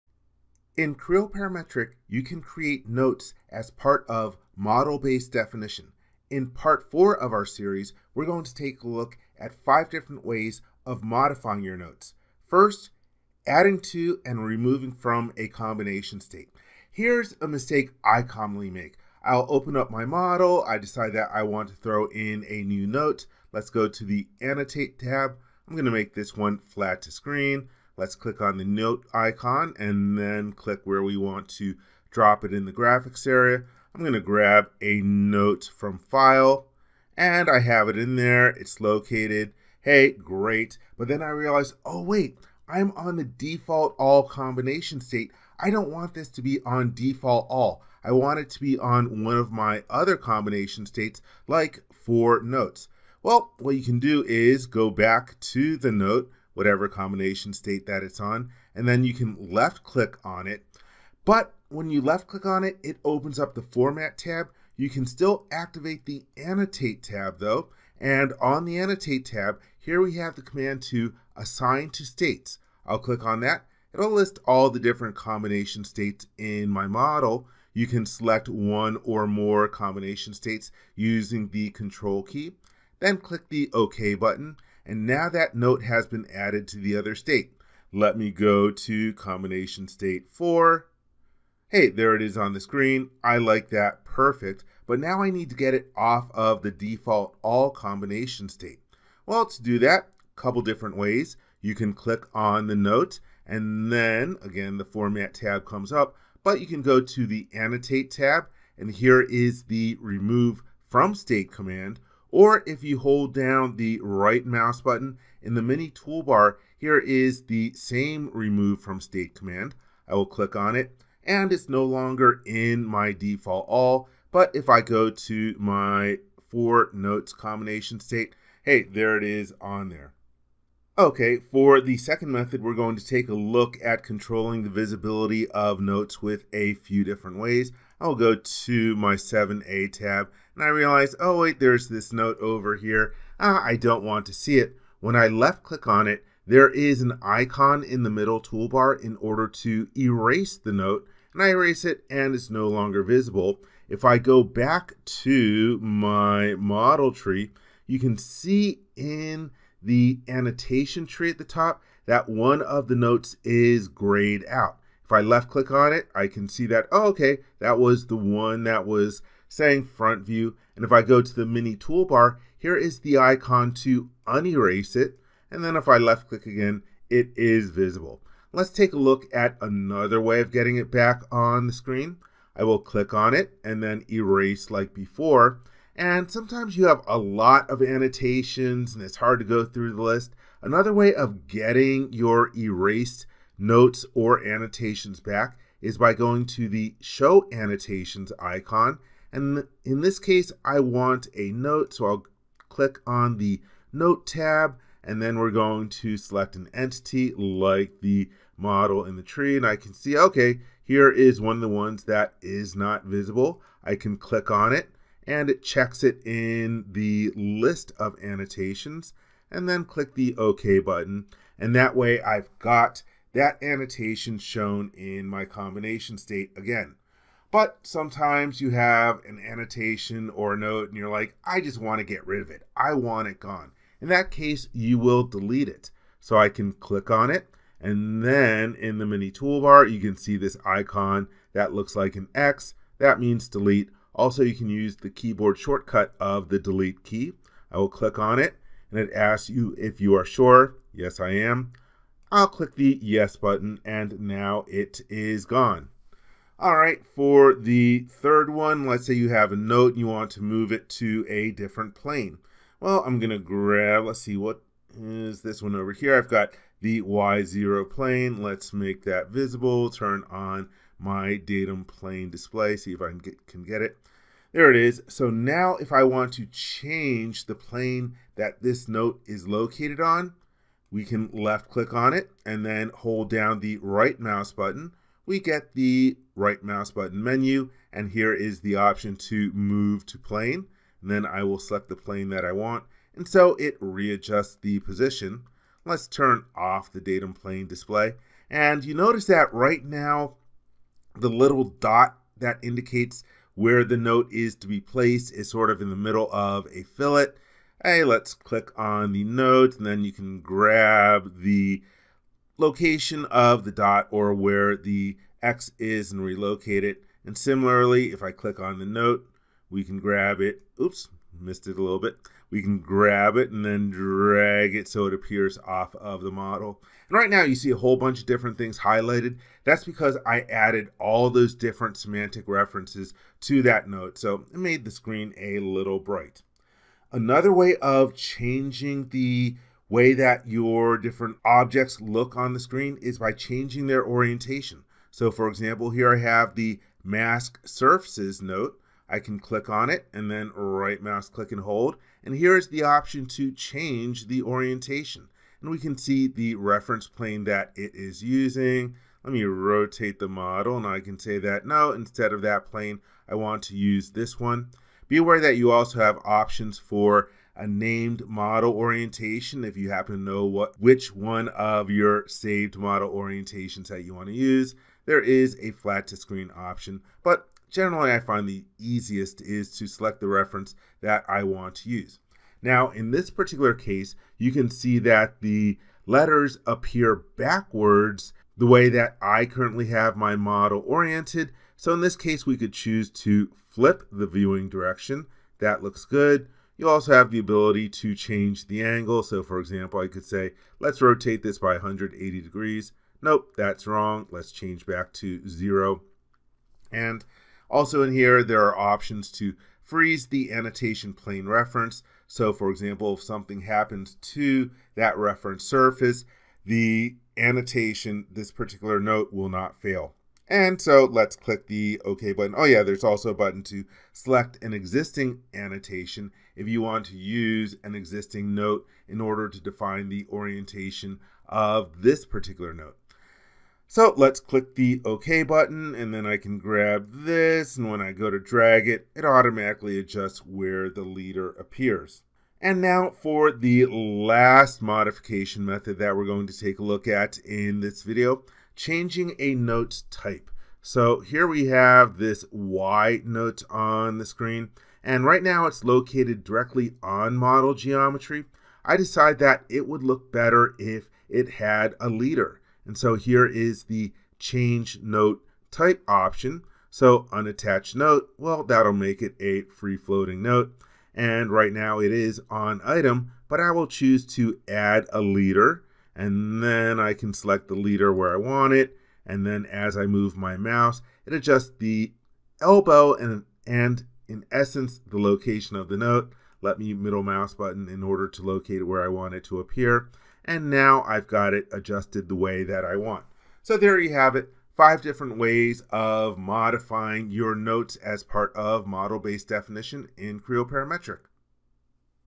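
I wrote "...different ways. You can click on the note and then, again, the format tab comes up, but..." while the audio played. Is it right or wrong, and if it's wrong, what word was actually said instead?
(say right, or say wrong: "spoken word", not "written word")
right.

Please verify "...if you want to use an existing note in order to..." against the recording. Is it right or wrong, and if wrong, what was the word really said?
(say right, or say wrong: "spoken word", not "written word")
right.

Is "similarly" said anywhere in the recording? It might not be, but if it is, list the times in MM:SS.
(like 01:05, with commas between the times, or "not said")
05:17.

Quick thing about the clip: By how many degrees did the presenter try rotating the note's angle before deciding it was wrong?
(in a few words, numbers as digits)
180.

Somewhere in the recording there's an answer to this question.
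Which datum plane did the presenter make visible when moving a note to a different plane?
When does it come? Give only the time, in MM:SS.
04:27.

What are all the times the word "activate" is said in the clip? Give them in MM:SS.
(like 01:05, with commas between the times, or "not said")
01:05.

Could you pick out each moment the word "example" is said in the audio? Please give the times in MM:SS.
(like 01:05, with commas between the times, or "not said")
05:45, 06:39, 06:52.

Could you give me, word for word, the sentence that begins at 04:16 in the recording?
All right, for the third one, let's say you have a note and you want to move it to a different plane.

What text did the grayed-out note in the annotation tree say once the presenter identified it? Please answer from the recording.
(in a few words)
front view.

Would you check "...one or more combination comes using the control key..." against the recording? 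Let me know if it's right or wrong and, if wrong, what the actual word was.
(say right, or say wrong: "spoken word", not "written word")
wrong: "states", not "comes".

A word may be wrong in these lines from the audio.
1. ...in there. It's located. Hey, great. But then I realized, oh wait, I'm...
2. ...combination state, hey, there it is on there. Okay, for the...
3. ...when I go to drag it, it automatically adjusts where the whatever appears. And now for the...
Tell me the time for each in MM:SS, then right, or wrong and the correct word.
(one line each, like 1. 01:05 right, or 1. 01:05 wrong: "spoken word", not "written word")
1. 00:37 right
2. 02:07 right
3. 07:17 wrong: "leader", not "whatever".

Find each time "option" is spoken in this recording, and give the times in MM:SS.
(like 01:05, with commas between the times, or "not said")
04:48, 05:52, 06:06, 06:16, 06:48, 07:46.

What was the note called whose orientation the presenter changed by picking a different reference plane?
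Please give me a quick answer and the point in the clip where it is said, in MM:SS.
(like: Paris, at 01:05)
mask surfaces, at 05:47.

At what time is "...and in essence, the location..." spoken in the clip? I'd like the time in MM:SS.
08:03.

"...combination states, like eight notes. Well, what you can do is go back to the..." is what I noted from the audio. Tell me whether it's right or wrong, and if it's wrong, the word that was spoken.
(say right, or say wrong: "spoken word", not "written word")
wrong: "four", not "eight".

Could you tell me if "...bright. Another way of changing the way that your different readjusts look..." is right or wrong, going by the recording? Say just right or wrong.
wrong.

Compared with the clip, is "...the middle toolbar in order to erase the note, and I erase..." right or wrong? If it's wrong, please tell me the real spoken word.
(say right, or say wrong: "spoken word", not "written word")
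right.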